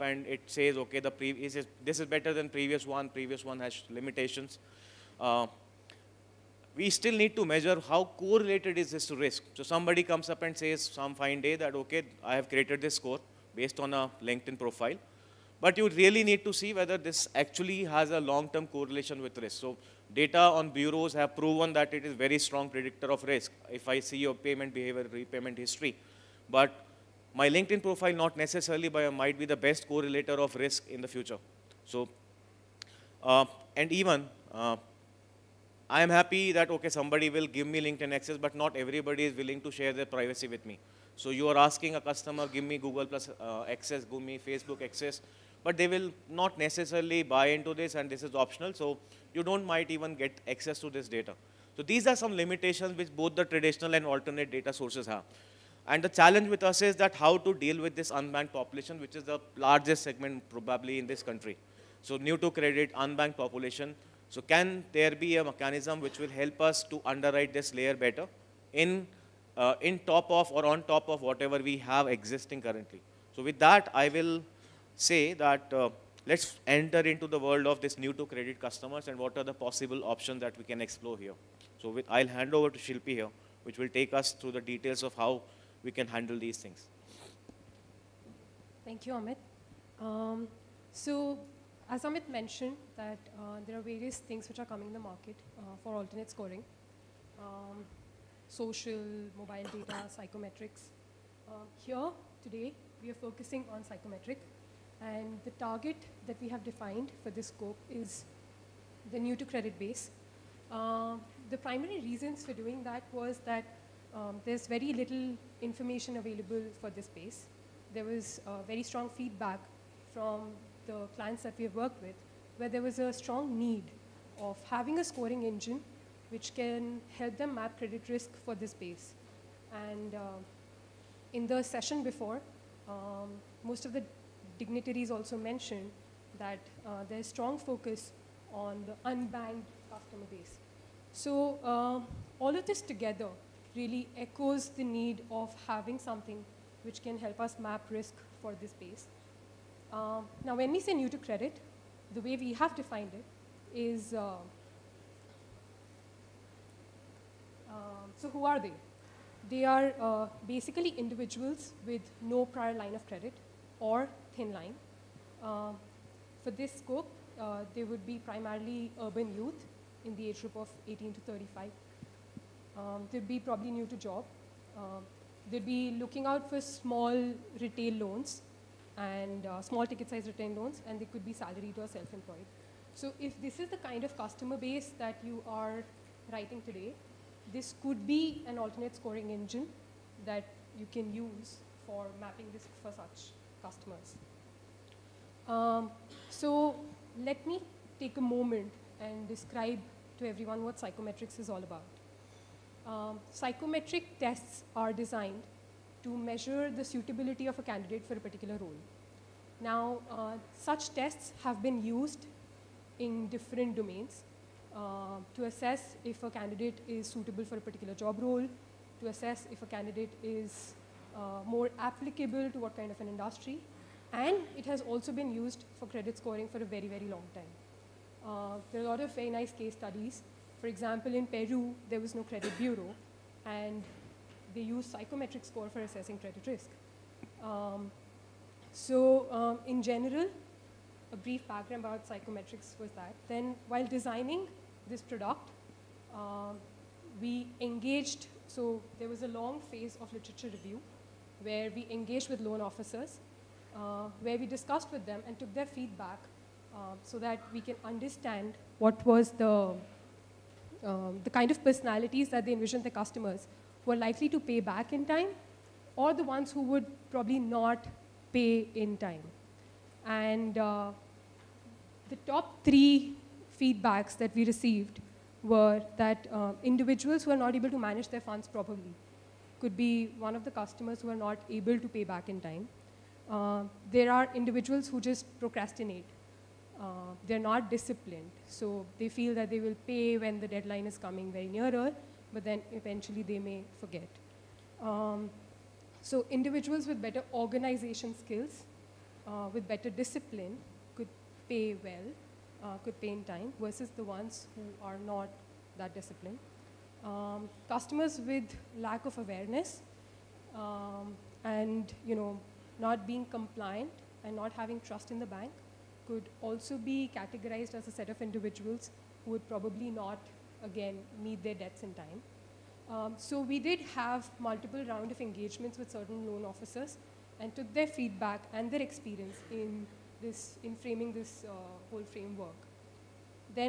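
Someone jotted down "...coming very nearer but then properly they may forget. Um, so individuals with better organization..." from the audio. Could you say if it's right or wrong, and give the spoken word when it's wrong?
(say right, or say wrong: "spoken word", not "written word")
wrong: "eventually", not "properly".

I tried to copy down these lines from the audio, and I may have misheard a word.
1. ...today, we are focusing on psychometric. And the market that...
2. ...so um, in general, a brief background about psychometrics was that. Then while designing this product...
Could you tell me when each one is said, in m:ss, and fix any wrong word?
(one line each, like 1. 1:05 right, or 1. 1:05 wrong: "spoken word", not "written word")
1. 1:42 wrong: "target", not "market"
2. 3:58 right.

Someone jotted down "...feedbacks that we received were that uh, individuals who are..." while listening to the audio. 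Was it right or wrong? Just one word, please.
right.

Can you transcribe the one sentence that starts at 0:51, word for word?
So these are some limitations which both the traditional and alternate data sources have.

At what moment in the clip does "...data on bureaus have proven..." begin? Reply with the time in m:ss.
0:20.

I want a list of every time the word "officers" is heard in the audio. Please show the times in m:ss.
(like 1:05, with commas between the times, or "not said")
4:12, 5:26.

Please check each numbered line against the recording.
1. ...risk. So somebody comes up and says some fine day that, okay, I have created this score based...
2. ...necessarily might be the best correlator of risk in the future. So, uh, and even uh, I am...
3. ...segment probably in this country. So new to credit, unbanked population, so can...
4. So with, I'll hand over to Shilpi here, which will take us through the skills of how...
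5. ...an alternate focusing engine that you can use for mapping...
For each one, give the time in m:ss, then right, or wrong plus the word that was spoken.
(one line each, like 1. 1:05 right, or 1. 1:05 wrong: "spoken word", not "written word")
1. 0:09 right
2. 0:28 right
3. 1:00 right
4. 1:21 wrong: "details", not "skills"
5. 3:08 wrong: "scoring", not "focusing".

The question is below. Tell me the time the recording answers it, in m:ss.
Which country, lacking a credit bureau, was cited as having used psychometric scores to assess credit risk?
3:51.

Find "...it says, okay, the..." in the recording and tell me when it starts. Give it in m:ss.
0:00.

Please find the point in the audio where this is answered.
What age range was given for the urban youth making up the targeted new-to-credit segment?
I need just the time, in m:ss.
2:50.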